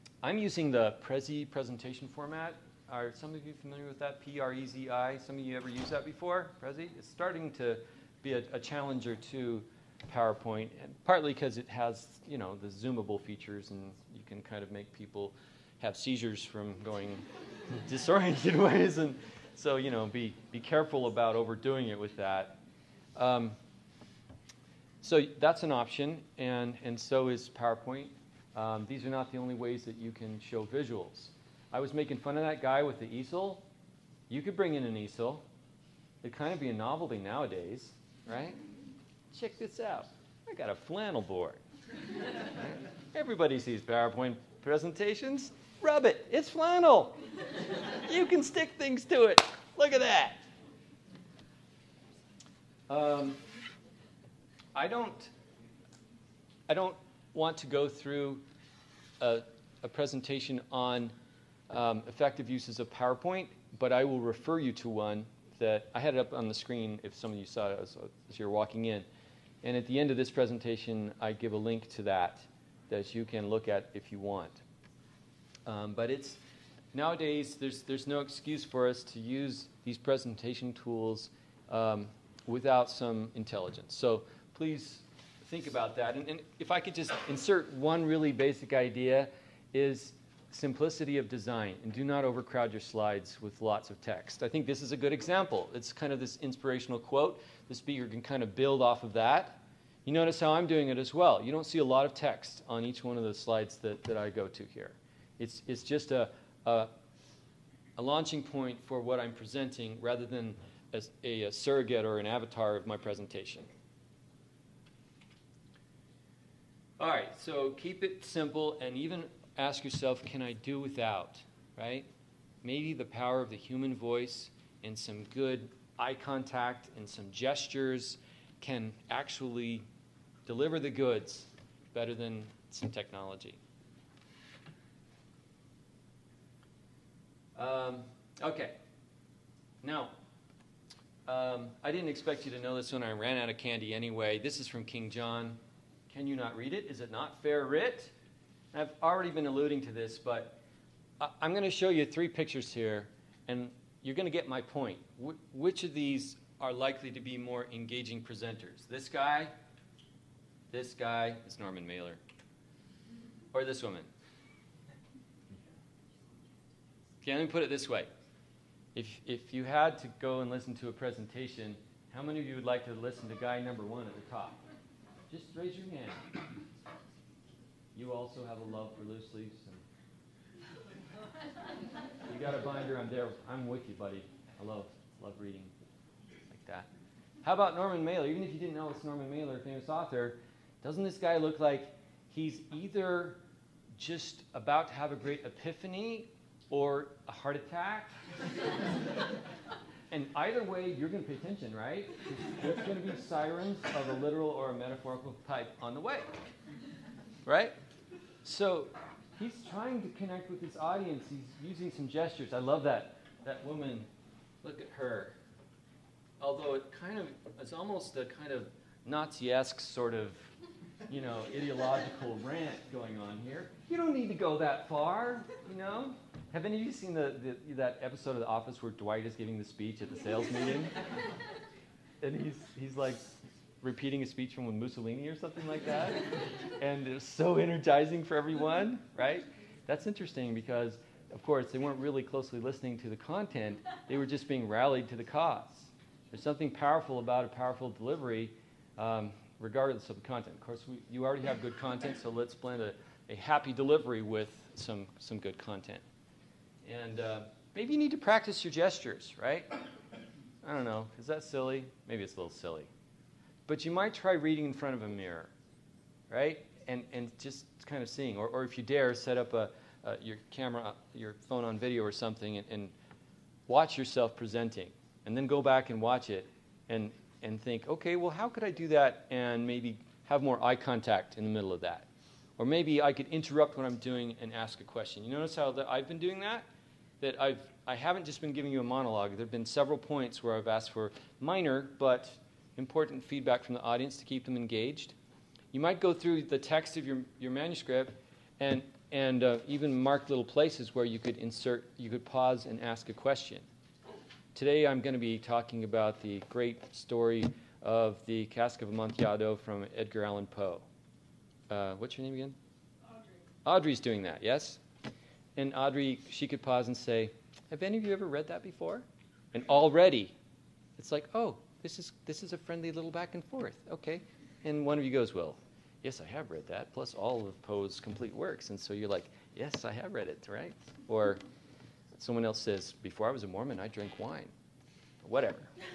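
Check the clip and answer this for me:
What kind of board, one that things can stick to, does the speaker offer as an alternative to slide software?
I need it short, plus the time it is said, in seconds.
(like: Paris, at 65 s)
flannel board, at 40 s.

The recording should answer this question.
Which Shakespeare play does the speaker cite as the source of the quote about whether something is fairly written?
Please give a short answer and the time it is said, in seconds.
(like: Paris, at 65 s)
King John, at 144 s.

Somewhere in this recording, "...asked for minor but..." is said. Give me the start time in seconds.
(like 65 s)
290 s.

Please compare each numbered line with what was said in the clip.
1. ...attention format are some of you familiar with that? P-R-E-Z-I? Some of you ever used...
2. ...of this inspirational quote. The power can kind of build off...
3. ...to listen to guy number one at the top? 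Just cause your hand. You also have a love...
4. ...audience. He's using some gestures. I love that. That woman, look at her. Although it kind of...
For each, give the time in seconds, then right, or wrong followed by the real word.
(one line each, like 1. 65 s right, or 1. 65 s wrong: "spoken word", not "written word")
1. 1 s wrong: "presentation", not "attention"
2. 96 s wrong: "speaker", not "power"
3. 172 s wrong: "raise", not "cause"
4. 210 s right.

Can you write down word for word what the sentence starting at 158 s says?
This guy, this guy, it's Norman Mailer, or this woman?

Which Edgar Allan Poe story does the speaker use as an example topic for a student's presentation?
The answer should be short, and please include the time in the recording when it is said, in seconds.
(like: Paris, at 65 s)
The Cask of Amontillado, at 308 s.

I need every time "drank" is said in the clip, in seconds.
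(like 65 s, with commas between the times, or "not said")
333 s.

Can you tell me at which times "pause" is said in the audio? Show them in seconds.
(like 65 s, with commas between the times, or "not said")
302 s, 316 s.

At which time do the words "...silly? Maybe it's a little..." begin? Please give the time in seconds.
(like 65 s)
261 s.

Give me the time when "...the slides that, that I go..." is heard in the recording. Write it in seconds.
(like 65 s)
103 s.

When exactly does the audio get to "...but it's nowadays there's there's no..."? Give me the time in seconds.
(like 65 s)
75 s.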